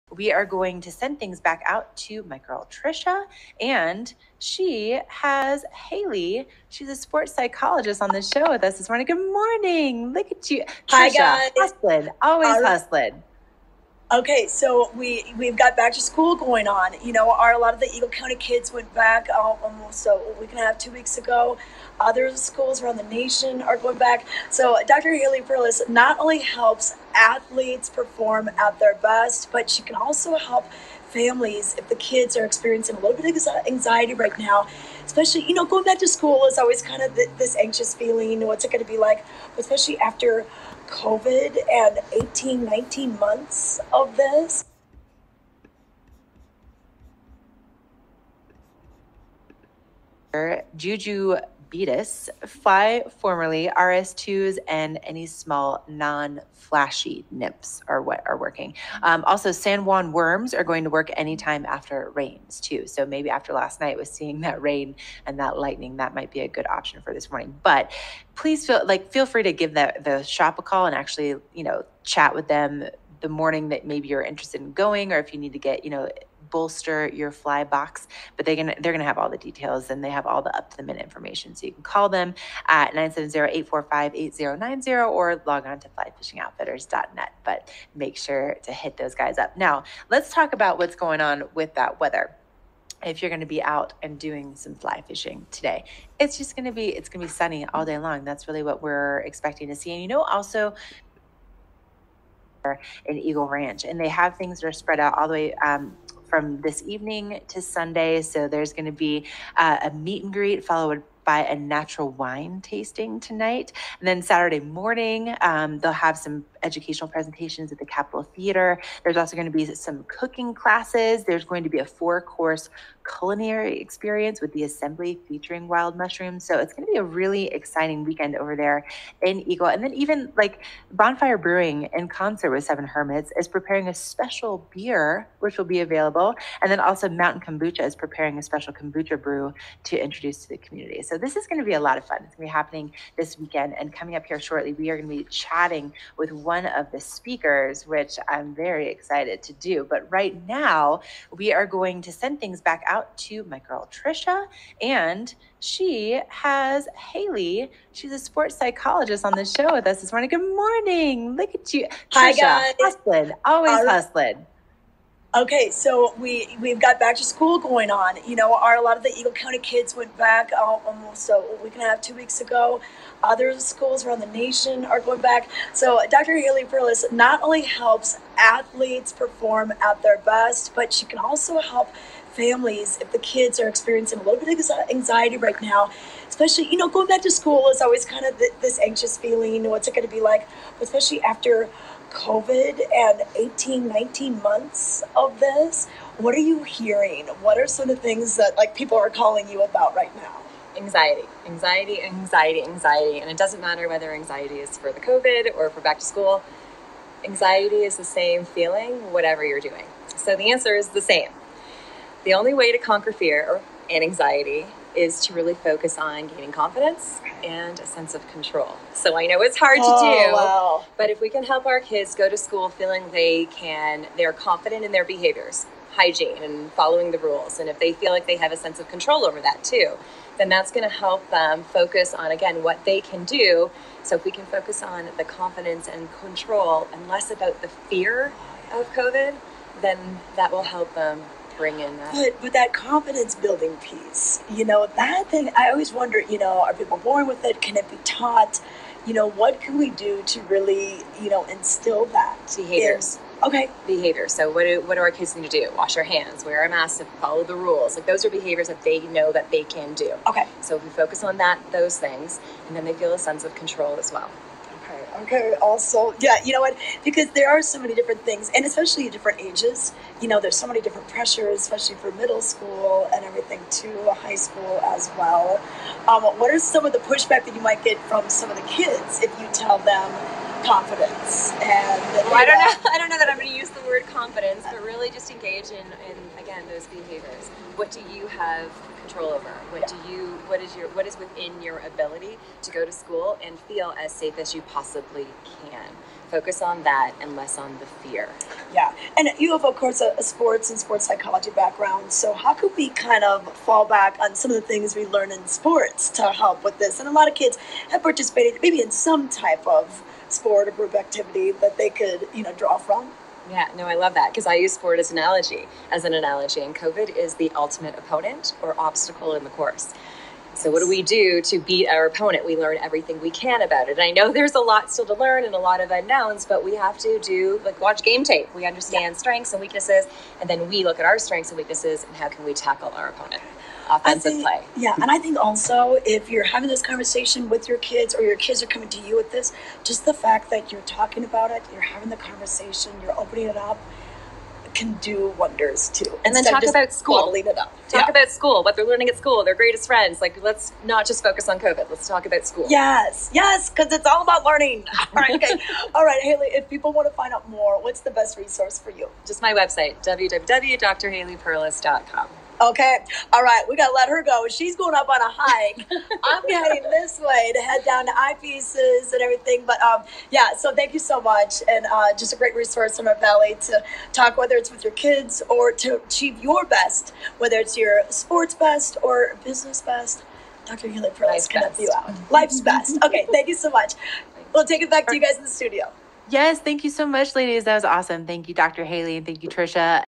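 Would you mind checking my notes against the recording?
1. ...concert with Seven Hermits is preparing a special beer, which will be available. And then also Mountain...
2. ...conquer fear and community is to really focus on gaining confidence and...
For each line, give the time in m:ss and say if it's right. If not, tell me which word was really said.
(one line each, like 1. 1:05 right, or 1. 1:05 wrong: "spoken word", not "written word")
1. 2:12 right
2. 3:32 wrong: "anxiety", not "community".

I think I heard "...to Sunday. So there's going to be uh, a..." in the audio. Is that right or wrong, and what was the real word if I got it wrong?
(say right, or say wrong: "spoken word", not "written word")
right.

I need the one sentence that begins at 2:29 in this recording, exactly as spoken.
But right now, we are going to send things back out to my girl Trisha, and she has Haley.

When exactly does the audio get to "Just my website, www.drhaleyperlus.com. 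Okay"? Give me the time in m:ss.
5:59.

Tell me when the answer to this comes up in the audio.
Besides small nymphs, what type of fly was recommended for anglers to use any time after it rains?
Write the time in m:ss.
0:59.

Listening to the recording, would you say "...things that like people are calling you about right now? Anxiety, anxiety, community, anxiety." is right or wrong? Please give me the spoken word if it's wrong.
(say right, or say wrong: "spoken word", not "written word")
wrong: "anxiety", not "community".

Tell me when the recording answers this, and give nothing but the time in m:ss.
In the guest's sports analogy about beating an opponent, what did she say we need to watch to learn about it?
5:28.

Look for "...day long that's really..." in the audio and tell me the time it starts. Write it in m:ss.
1:37.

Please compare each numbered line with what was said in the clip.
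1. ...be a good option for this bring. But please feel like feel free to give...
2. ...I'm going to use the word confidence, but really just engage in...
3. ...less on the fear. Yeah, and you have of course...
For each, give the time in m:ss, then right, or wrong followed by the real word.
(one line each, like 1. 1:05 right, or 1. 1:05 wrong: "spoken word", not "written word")
1. 1:06 wrong: "morning", not "bring"
2. 4:43 right
3. 4:57 right.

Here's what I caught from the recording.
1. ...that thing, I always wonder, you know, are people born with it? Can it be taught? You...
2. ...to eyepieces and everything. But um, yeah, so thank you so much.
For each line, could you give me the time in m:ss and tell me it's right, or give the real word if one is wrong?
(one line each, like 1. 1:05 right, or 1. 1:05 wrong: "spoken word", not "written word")
1. 4:04 right
2. 6:08 right.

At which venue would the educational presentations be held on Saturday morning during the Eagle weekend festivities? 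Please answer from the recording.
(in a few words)
Capitol Theater.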